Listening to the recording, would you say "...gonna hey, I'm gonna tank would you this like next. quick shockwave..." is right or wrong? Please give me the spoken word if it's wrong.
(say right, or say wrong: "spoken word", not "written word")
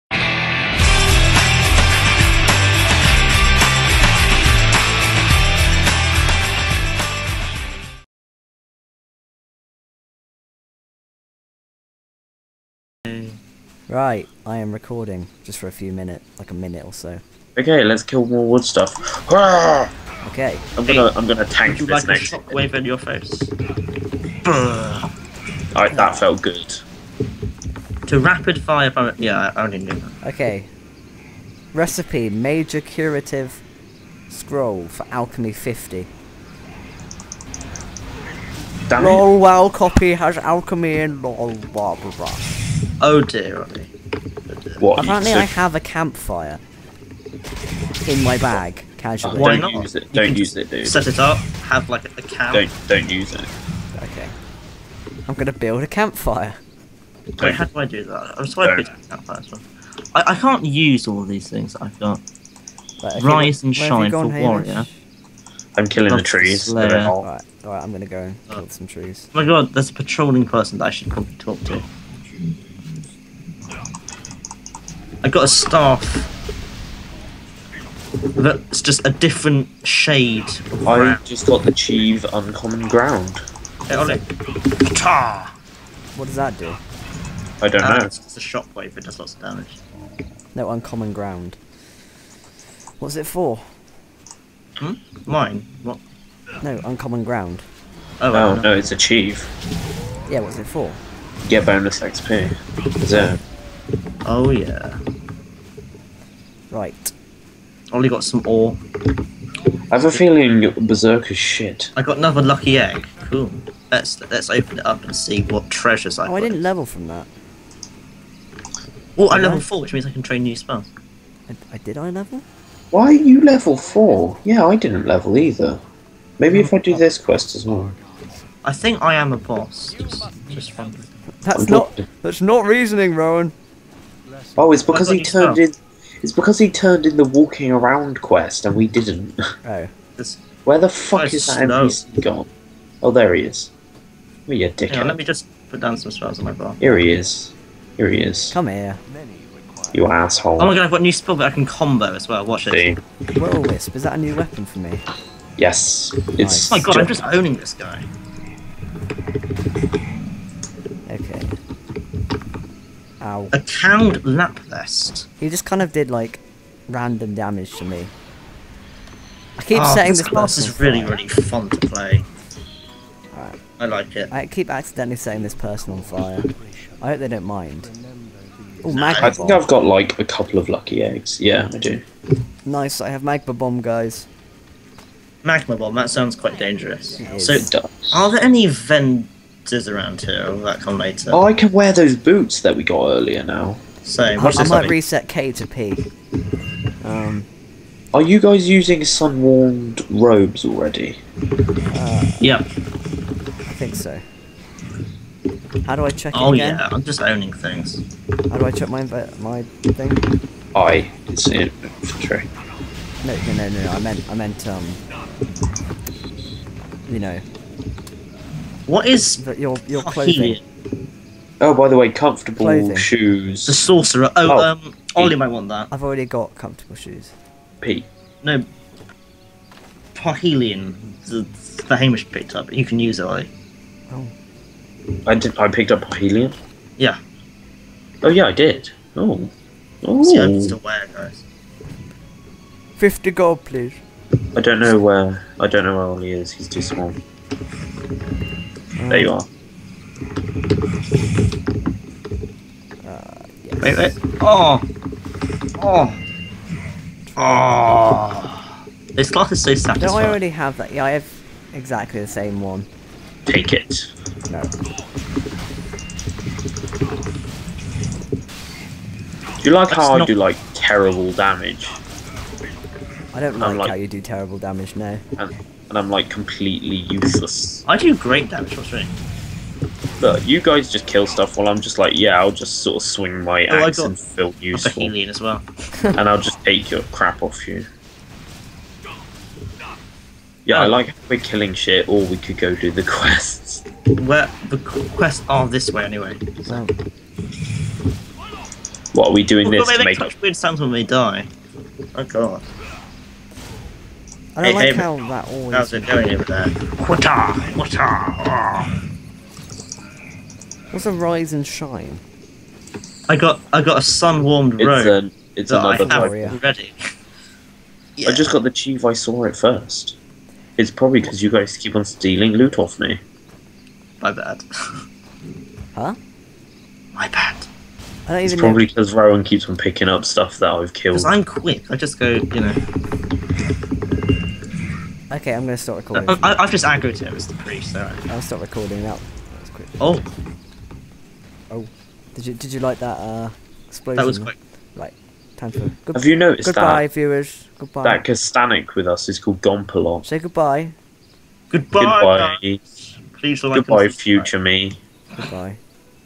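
wrong: "shock", not "quick".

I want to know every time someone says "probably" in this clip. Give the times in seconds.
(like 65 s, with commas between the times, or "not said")
71 s, 320 s, 328 s.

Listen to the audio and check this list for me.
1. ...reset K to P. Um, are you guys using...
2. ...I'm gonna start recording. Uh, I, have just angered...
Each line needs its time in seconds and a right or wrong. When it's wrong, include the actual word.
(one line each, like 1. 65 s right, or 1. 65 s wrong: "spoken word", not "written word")
1. 194 s right
2. 335 s right.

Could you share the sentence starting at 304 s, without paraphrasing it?
I don't hey, like hey, how that always.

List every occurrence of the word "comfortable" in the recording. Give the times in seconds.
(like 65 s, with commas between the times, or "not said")
222 s, 226 s.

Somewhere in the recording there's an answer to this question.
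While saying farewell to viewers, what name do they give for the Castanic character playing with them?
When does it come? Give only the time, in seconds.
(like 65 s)
349 s.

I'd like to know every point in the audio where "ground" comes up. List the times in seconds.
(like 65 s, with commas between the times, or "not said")
82 s, 91 s, 97 s.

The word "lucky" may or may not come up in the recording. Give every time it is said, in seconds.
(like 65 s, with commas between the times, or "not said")
112 s, 180 s.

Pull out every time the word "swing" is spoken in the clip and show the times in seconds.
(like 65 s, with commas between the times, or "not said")
278 s, 283 s.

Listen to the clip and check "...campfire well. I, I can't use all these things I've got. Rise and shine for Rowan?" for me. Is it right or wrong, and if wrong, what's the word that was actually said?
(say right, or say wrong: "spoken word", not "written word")
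wrong: "Hamish", not "Rowan".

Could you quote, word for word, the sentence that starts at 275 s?
Um, and I'm like completely useless.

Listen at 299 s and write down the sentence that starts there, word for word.
They make, make such weird sounds when we die.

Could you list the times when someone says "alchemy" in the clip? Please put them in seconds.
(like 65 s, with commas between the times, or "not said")
35 s, 40 s.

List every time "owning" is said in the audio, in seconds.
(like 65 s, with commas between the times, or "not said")
157 s, 207 s.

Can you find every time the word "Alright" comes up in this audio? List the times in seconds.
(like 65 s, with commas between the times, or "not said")
25 s, 66 s.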